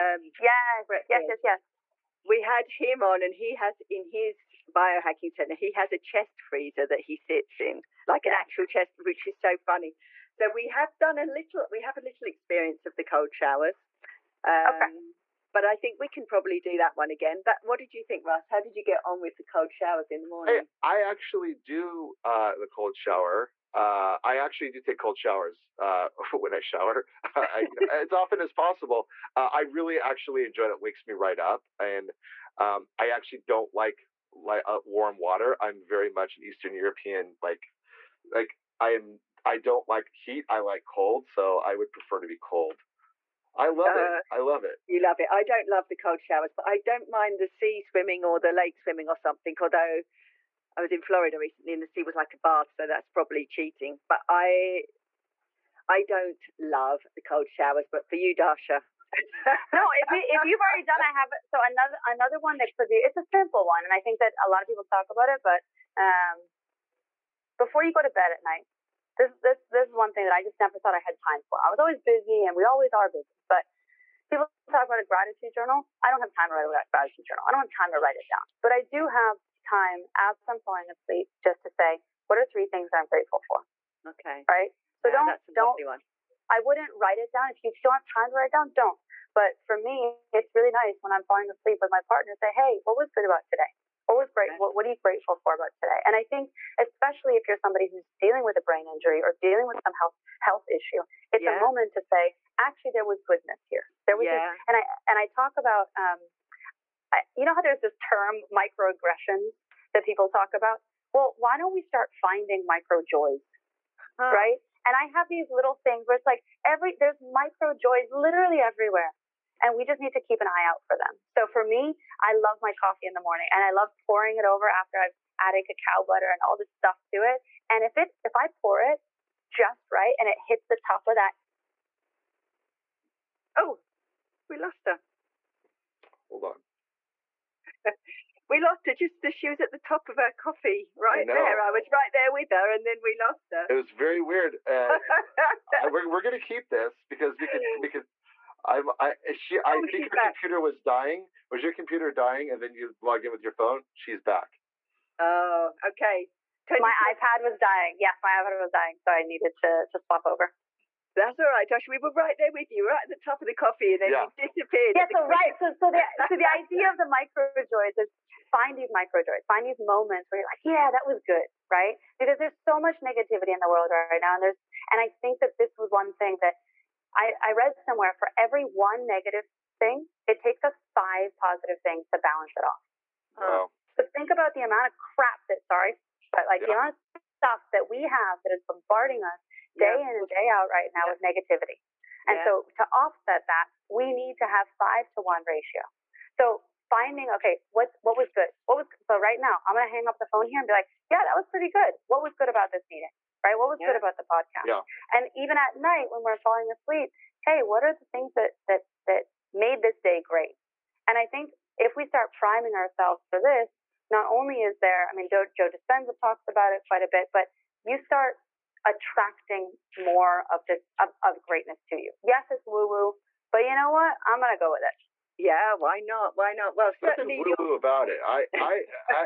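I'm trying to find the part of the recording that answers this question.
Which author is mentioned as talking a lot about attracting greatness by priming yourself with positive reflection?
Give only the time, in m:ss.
3:35.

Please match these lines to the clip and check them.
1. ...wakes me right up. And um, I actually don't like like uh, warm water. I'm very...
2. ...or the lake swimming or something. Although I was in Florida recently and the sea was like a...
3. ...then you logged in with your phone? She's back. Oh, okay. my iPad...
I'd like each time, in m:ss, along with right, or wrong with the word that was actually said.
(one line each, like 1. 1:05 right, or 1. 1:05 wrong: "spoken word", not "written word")
1. 0:30 right
2. 0:48 right
3. 2:32 right.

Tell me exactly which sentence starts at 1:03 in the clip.
It's a simple one, and I think that a lot of people talk about it.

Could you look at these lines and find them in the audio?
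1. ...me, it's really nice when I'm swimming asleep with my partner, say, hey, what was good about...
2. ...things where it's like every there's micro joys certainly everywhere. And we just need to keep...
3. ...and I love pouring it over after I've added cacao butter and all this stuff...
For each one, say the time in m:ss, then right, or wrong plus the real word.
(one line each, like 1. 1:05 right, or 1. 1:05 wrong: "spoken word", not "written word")
1. 1:29 wrong: "falling", not "swimming"
2. 1:55 wrong: "literally", not "certainly"
3. 2:03 right.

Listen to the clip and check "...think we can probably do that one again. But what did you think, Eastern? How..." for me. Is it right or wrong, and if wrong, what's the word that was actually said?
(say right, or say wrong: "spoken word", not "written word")
wrong: "Russ", not "Eastern".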